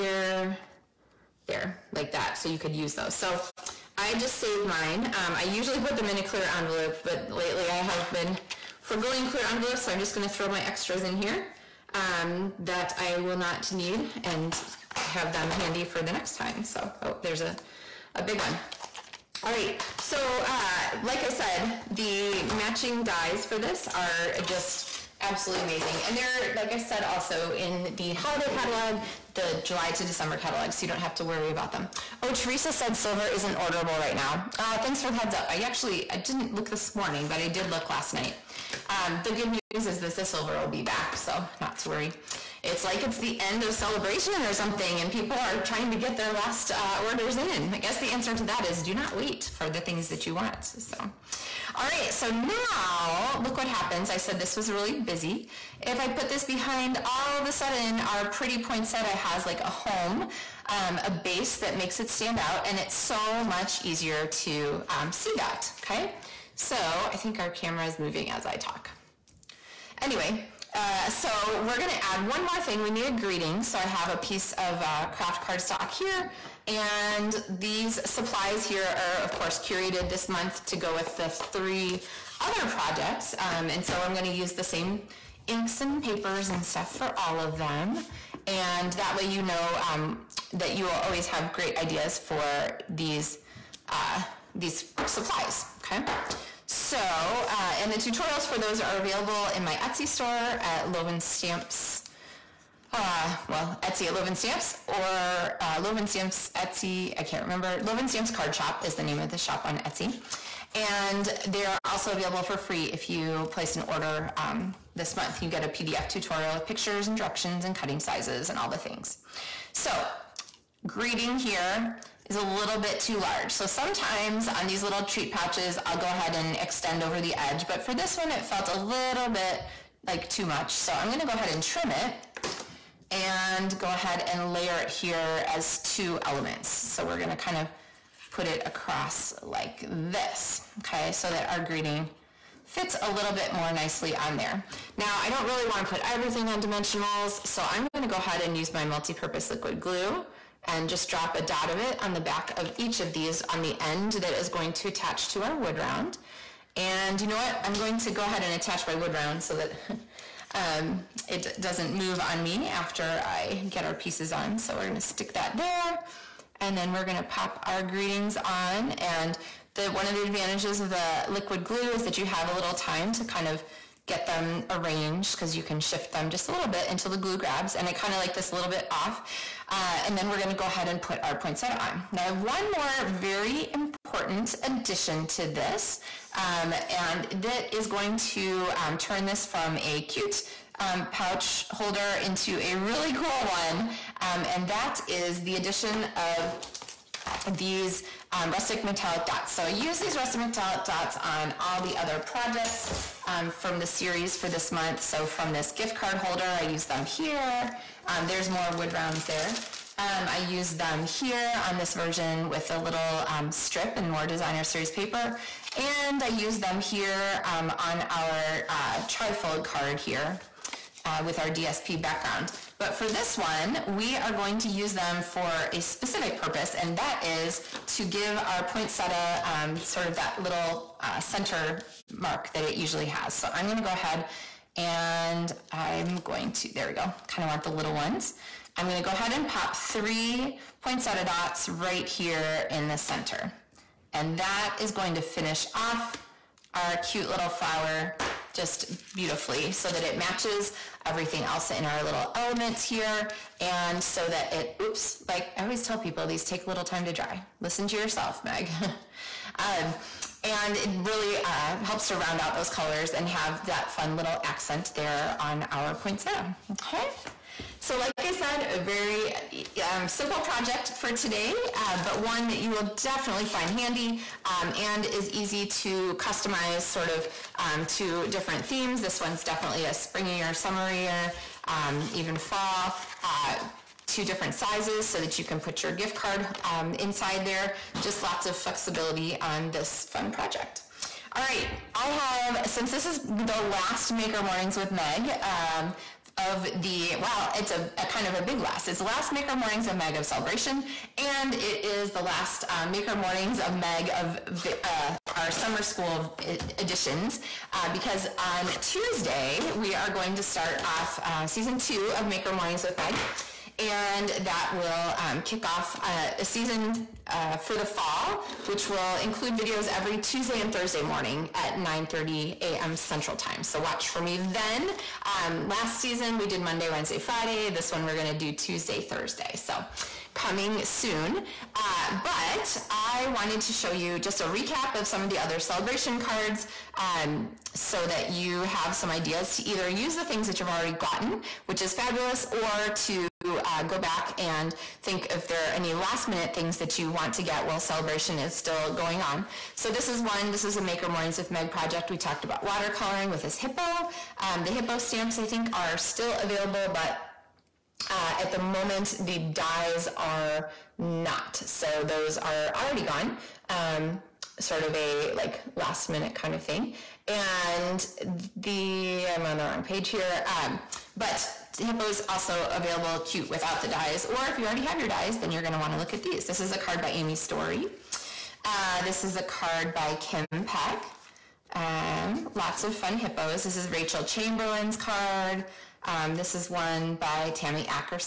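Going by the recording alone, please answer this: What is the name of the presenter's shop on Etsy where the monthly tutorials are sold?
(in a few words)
Loven Stamps Card Shop.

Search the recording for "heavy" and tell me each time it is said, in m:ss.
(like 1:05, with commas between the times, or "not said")
not said.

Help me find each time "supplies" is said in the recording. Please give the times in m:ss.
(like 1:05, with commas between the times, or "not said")
1:18, 1:35.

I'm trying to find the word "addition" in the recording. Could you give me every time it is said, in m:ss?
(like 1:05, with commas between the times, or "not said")
3:04, 3:15.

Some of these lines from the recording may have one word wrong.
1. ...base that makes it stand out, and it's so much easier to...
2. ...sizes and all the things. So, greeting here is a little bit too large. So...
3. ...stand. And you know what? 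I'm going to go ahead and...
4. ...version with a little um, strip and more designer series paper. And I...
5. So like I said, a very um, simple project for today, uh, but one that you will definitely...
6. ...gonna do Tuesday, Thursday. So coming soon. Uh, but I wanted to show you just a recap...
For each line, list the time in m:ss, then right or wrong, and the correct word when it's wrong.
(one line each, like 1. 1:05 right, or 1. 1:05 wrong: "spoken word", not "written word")
1. 1:01 right
2. 1:57 right
3. 2:35 wrong: "round", not "stand"
4. 3:31 right
5. 4:27 right
6. 5:28 right.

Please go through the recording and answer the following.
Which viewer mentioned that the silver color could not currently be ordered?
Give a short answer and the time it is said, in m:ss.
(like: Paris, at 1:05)
Teresa, at 0:32.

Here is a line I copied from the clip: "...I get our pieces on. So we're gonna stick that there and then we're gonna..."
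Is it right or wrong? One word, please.
right.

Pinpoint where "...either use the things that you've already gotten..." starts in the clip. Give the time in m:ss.
5:39.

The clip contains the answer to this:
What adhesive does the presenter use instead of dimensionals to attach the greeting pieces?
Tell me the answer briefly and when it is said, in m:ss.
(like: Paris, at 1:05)
multi-purpose liquid glue, at 2:28.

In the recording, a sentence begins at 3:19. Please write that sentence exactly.
So I use these rustic metallic dots on all the other projects um, from the series for this month.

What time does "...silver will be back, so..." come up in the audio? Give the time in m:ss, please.
0:40.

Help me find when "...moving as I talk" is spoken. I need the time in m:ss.
1:07.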